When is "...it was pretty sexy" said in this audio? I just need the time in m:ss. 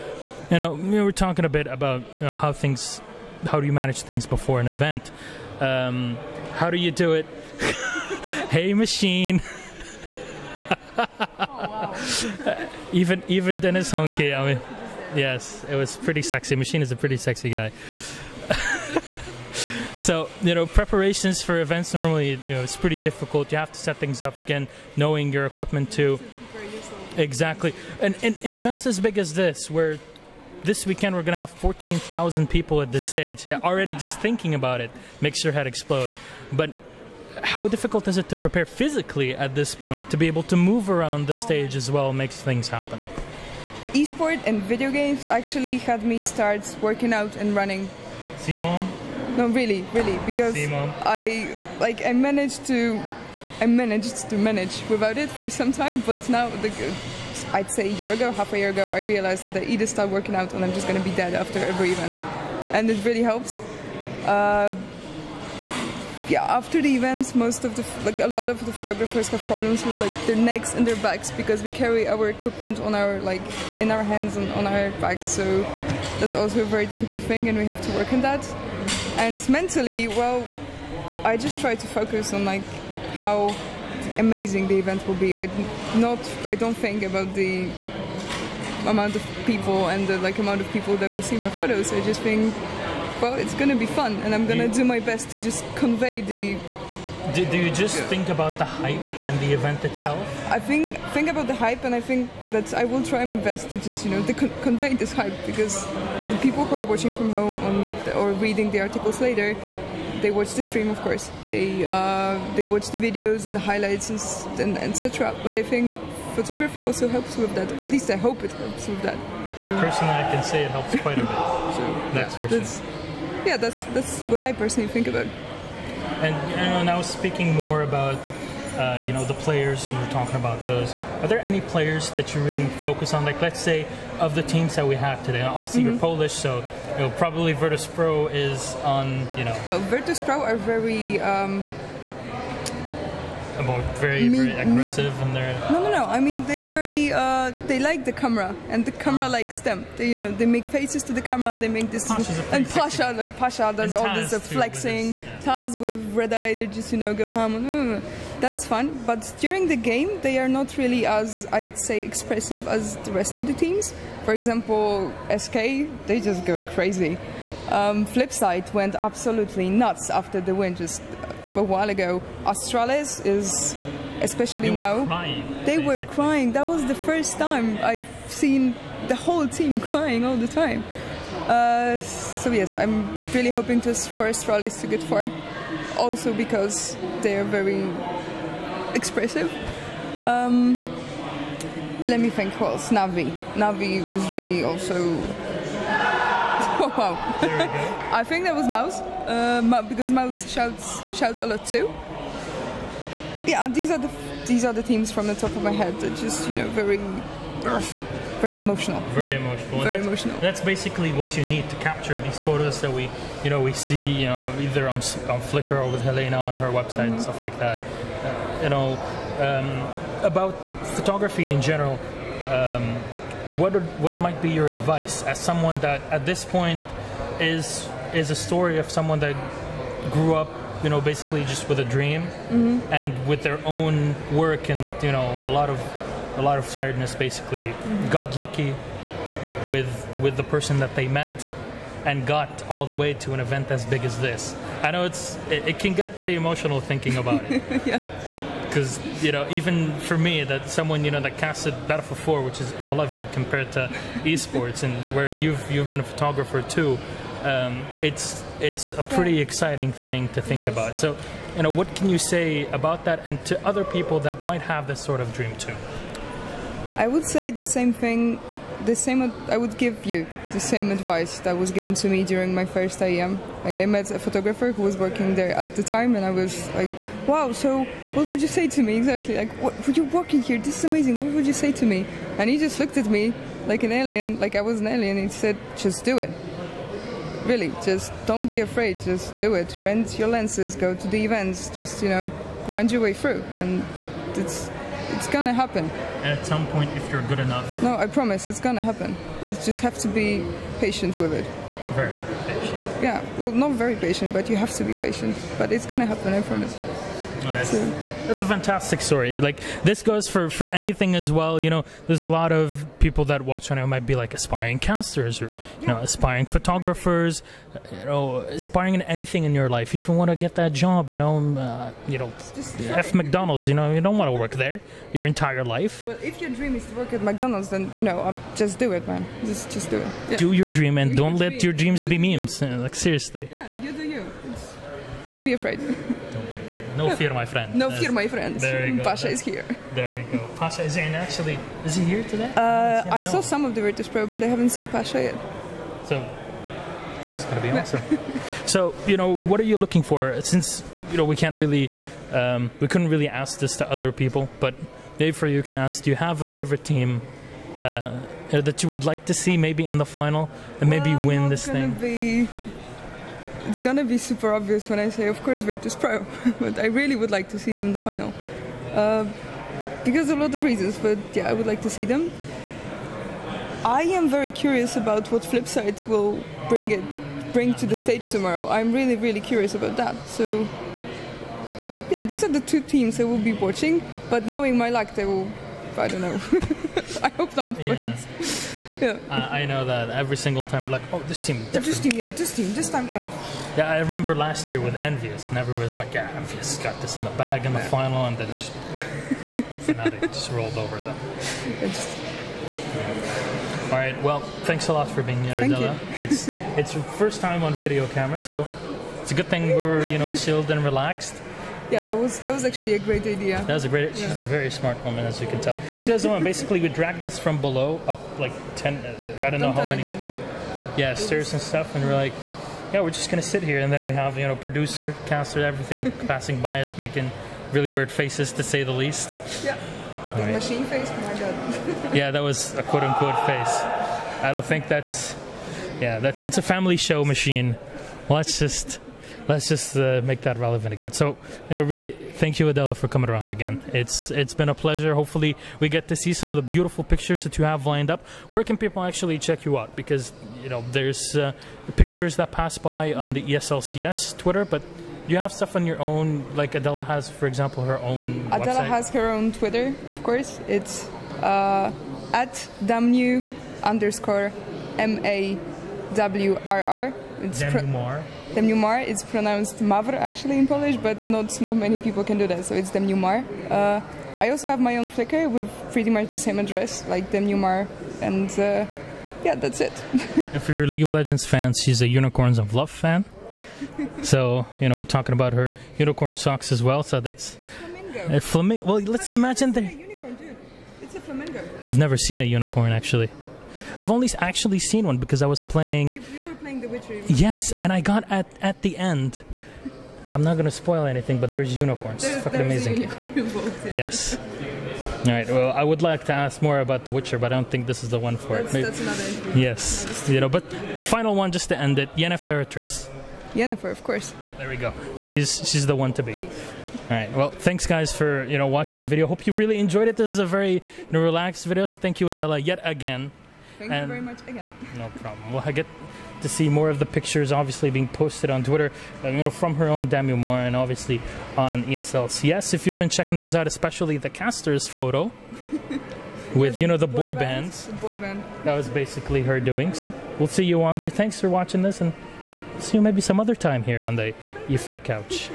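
0:15.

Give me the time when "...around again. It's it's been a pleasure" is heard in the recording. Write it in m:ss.
7:23.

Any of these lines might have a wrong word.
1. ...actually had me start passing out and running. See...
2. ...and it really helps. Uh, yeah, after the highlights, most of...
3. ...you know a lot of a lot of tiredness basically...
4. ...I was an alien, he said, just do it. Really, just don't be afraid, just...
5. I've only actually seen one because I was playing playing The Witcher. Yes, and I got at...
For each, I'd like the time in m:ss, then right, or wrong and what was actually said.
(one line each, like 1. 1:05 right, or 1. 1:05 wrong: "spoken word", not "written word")
1. 0:45 wrong: "working", not "passing"
2. 1:02 wrong: "events", not "highlights"
3. 3:55 right
4. 4:44 right
5. 8:13 right.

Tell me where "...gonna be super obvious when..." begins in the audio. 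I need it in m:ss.
6:03.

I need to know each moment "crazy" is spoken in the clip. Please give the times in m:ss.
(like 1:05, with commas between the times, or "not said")
2:46.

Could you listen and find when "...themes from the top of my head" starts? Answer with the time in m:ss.
3:24.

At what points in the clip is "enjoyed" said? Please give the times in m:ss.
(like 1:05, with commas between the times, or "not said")
8:39.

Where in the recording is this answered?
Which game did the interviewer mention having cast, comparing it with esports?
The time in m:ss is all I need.
4:11.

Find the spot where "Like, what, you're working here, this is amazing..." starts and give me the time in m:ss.
4:39.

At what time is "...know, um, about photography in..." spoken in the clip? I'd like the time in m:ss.
3:38.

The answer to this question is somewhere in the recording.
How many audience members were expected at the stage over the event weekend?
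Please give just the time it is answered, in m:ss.
0:31.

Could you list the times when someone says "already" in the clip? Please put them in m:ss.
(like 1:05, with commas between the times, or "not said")
0:33.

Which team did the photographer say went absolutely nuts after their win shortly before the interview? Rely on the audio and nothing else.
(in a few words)
FlipSid3.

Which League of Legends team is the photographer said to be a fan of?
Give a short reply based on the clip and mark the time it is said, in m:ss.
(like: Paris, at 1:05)
Unicorns of Love, at 8:02.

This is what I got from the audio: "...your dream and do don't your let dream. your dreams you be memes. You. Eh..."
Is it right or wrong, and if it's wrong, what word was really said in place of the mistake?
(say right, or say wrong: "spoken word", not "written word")
right.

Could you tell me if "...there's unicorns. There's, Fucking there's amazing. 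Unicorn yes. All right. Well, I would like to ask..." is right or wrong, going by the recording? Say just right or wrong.
right.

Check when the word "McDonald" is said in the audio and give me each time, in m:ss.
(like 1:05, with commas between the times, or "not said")
5:23, 5:27.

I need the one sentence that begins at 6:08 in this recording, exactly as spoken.
Uh, because a lot of reasons, but yeah, I would like to see them.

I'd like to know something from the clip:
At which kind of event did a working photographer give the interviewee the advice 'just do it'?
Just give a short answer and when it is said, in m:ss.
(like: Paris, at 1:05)
IEM, at 4:32.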